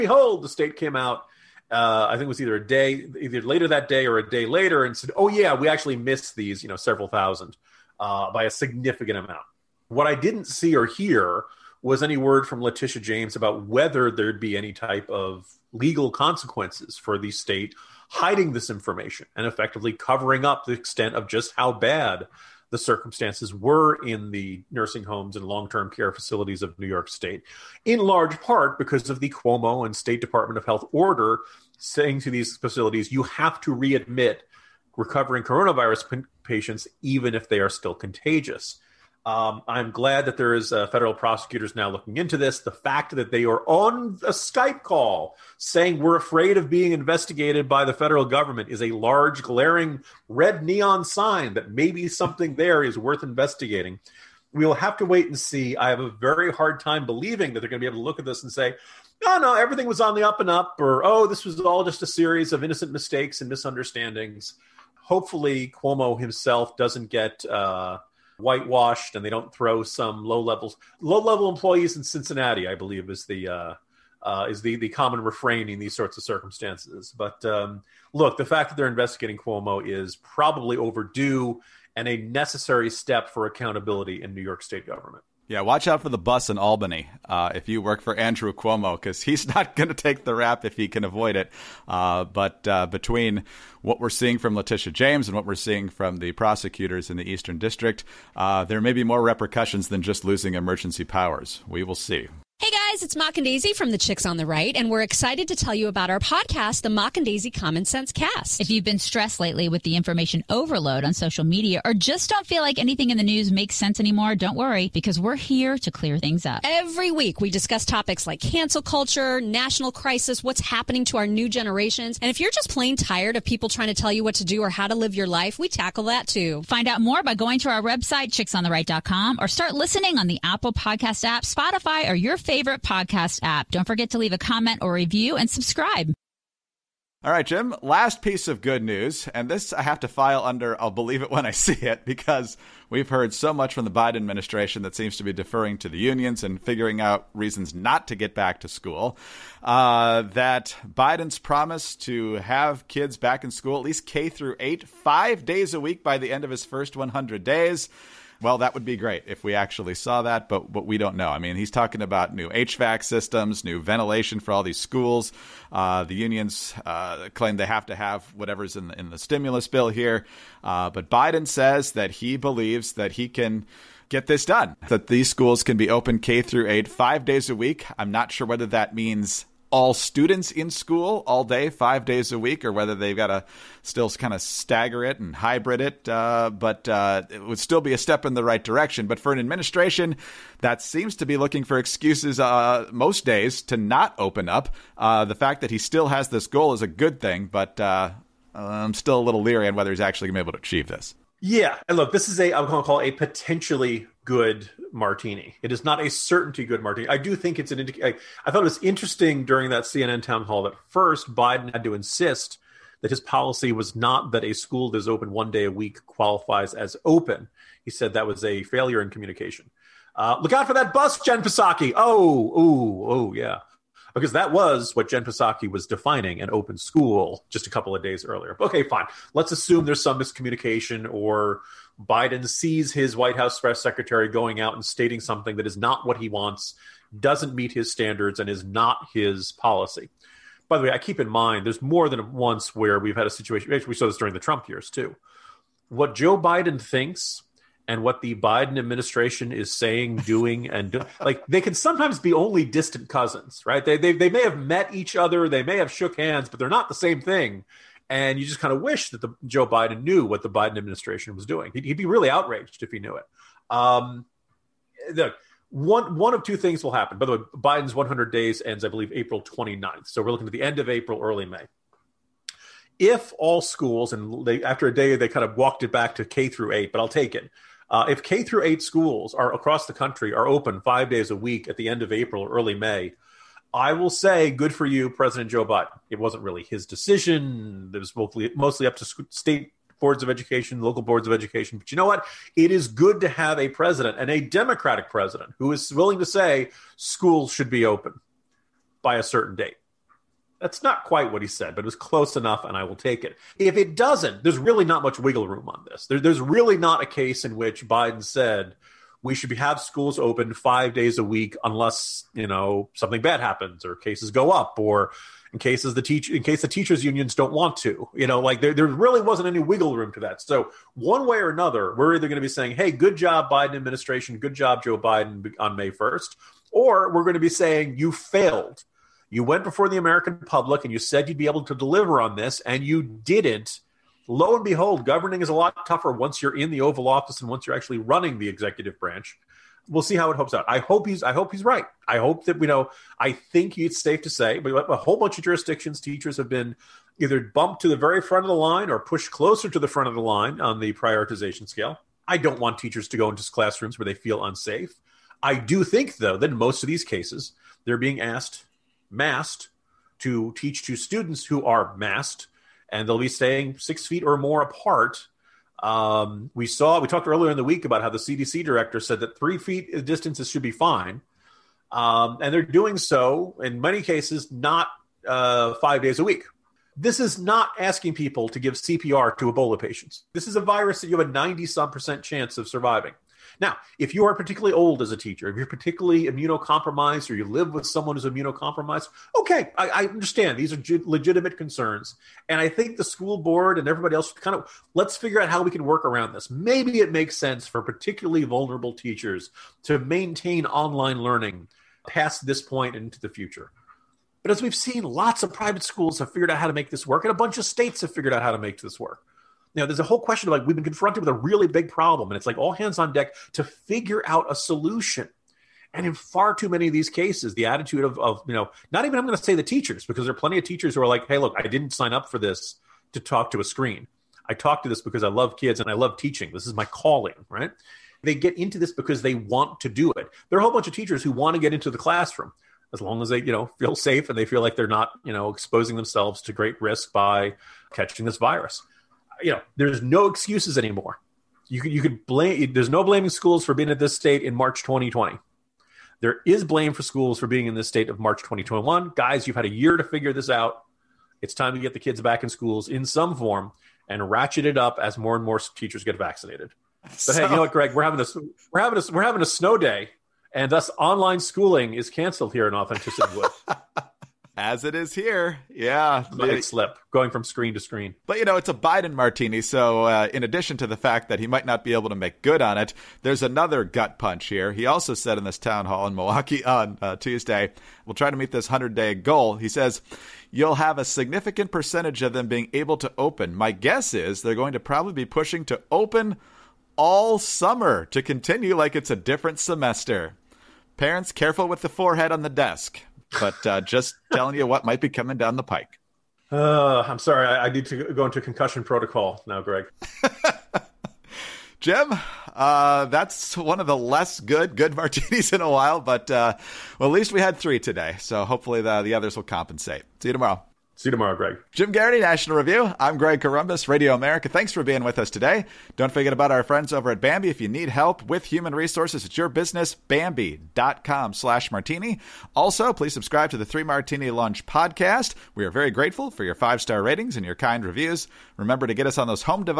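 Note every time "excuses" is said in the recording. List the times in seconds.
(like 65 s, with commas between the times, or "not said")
191 s, 440 s.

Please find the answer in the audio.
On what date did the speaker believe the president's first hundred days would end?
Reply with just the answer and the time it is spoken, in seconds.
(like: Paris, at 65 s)
April 29, at 269 s.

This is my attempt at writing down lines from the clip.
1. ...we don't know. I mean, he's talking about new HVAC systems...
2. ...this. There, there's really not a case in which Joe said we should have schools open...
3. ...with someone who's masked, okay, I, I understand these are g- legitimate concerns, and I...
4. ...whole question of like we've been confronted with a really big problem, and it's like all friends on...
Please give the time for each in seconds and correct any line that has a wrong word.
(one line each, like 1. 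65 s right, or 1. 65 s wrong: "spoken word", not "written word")
1. 160 s right
2. 305 s wrong: "Biden", not "Joe"
3. 387 s wrong: "immunocompromised", not "masked"
4. 410 s wrong: "hands", not "friends".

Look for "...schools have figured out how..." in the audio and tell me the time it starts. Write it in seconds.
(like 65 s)
405 s.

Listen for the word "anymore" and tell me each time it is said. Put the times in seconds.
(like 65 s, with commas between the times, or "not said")
113 s, 440 s.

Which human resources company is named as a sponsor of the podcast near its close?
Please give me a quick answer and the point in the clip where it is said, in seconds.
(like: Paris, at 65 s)
Bambee, at 517 s.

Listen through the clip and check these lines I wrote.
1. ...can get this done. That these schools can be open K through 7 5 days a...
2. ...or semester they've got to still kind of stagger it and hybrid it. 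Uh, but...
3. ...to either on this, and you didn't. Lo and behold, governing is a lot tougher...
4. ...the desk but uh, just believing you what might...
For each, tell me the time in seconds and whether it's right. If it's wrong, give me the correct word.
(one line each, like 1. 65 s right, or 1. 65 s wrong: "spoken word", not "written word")
1. 173 s wrong: "8", not "7"
2. 182 s wrong: "whether", not "semester"
3. 331 s wrong: "deliver", not "either"
4. 492 s wrong: "telling", not "believing".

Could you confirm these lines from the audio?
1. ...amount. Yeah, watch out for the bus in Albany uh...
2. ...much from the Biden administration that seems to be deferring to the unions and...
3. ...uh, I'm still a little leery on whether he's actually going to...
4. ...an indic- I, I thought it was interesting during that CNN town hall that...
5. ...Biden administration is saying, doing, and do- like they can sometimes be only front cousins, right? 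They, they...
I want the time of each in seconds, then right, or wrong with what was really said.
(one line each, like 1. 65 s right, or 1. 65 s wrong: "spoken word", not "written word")
1. 84 s wrong: "government", not "amount"
2. 143 s right
3. 197 s right
4. 207 s right
5. 248 s wrong: "distant", not "front".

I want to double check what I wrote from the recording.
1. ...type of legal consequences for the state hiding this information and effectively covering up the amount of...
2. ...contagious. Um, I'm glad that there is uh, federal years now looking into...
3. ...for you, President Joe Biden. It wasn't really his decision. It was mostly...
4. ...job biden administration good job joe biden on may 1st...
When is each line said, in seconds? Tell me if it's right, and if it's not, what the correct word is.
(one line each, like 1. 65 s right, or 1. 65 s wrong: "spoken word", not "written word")
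1. 14 s wrong: "extent", not "amount"
2. 37 s wrong: "prosecutors", not "years"
3. 284 s right
4. 323 s right.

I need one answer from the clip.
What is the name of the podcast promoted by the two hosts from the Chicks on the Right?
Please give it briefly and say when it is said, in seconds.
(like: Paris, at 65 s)
Mock and Daisy Common Sense Cast, at 106 s.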